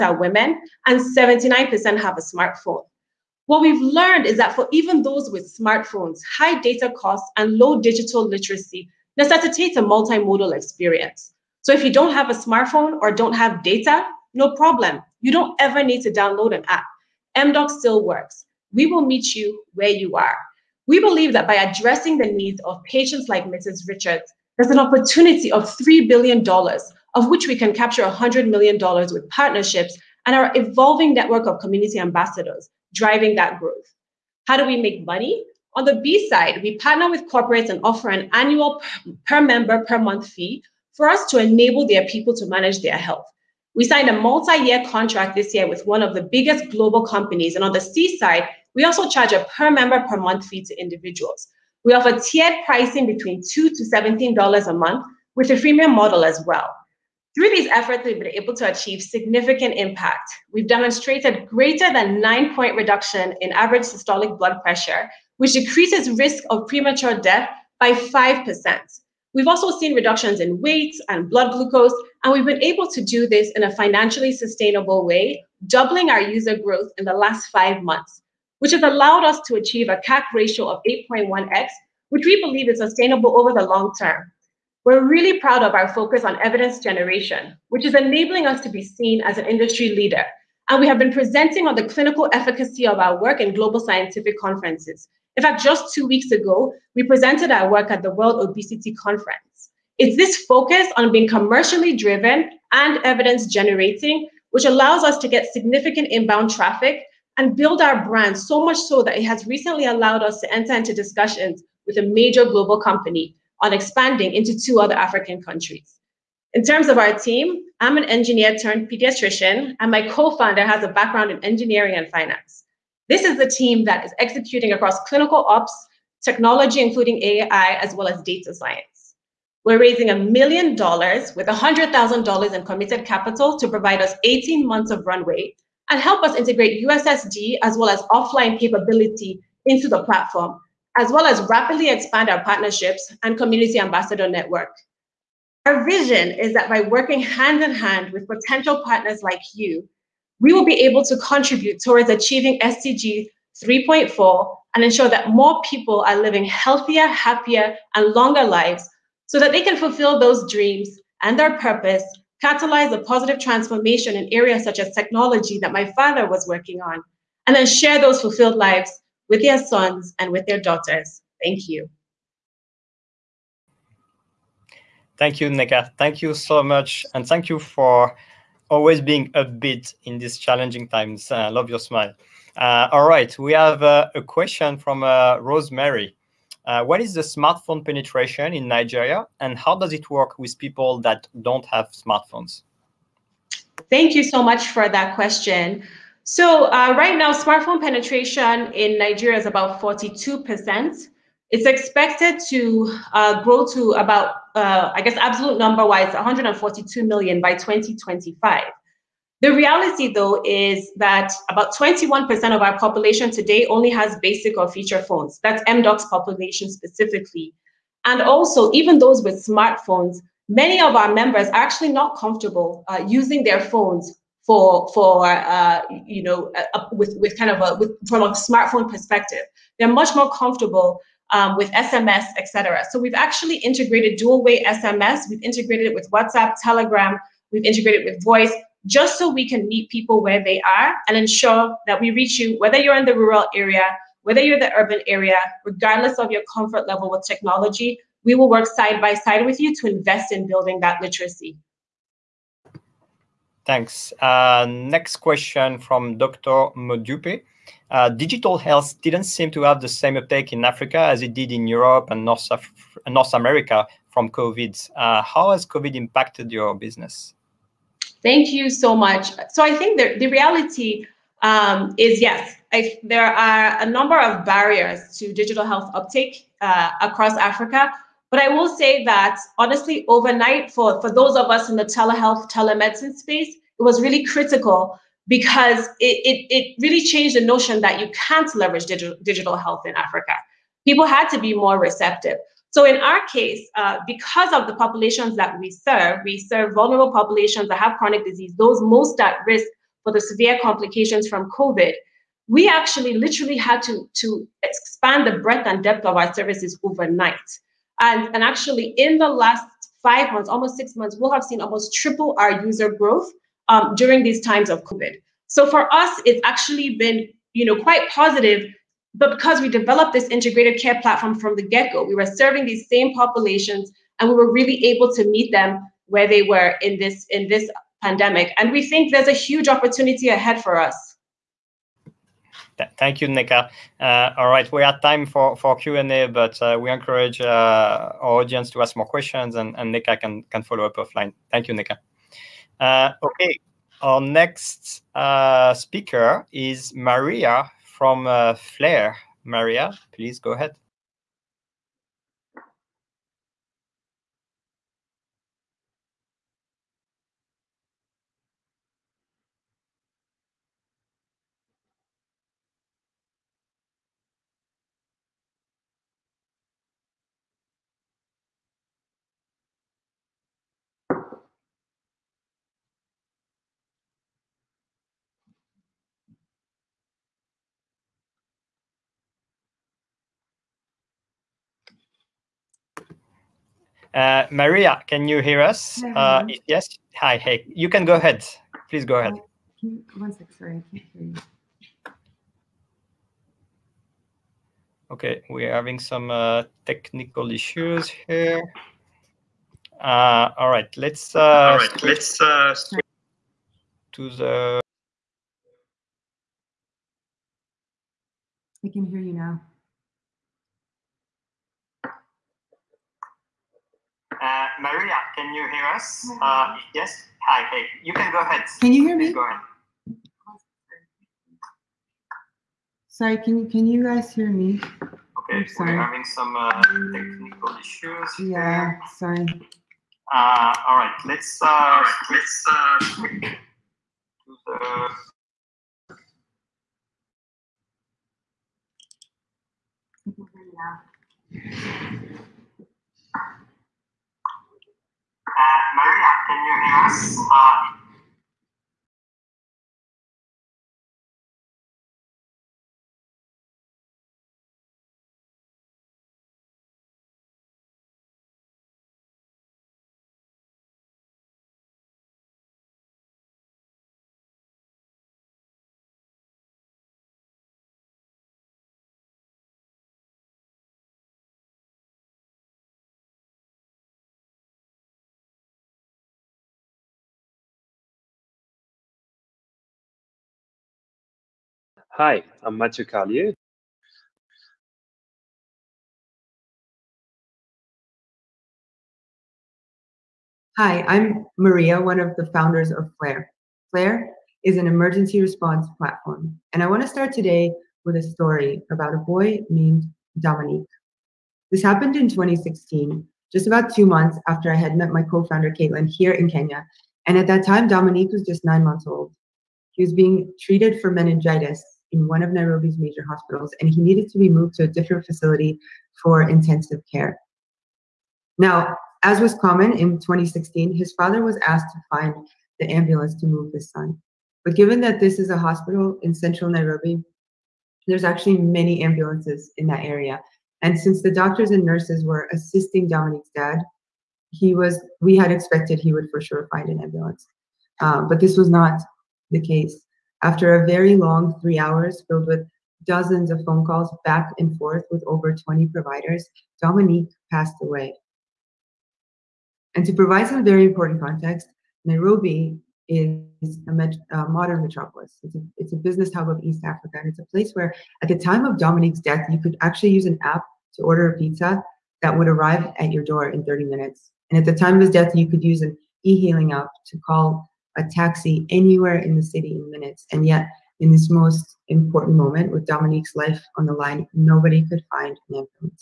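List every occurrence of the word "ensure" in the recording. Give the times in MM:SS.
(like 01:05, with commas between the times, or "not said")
02:34, 04:01.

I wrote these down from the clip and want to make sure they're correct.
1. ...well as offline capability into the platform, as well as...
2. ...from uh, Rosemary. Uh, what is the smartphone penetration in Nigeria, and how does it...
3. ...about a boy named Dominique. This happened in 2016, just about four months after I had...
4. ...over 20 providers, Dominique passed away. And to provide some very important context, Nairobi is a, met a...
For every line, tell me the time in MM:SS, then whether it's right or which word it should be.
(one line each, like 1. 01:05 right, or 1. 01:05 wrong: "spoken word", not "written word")
1. 02:17 right
2. 03:04 right
3. 08:18 wrong: "two", not "four"
4. 09:05 right.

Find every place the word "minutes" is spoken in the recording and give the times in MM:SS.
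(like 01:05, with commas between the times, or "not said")
09:23, 09:29.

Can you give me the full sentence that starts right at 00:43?
We signed a multi-year contract this year with one of the biggest global companies.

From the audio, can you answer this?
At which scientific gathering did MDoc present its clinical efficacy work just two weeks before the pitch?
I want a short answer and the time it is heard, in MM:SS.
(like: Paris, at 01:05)
World Obesity Conference, at 01:38.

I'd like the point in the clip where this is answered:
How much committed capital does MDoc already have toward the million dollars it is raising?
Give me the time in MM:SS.
02:11.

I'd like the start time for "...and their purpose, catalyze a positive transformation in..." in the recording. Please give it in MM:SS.
02:41.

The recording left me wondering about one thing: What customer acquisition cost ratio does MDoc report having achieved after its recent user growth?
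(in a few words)
8.1x.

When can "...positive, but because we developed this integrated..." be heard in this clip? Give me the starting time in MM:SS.
05:18.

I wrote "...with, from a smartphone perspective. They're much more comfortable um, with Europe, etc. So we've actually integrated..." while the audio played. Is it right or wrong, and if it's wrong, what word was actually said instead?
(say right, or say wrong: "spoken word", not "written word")
wrong: "SMS", not "Europe".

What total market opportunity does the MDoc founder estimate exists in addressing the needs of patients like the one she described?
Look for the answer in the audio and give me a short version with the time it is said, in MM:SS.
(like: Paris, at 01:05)
$3 billion, at 00:25.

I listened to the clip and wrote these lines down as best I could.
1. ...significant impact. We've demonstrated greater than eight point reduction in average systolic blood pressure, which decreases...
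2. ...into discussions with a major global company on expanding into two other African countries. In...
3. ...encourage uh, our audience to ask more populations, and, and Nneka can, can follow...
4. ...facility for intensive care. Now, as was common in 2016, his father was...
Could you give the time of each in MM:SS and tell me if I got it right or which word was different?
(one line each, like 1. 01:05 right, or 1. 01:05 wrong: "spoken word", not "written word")
1. 00:59 wrong: "nine", not "eight"
2. 01:50 right
3. 05:36 wrong: "questions", not "populations"
4. 08:35 right.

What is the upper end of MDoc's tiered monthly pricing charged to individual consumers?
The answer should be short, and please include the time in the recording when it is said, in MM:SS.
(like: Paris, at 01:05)
$17, at 00:53.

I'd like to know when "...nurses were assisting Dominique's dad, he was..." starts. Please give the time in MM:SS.
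08:51.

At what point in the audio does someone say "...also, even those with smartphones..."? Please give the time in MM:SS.
03:38.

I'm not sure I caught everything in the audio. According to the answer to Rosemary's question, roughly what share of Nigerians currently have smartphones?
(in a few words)
42%.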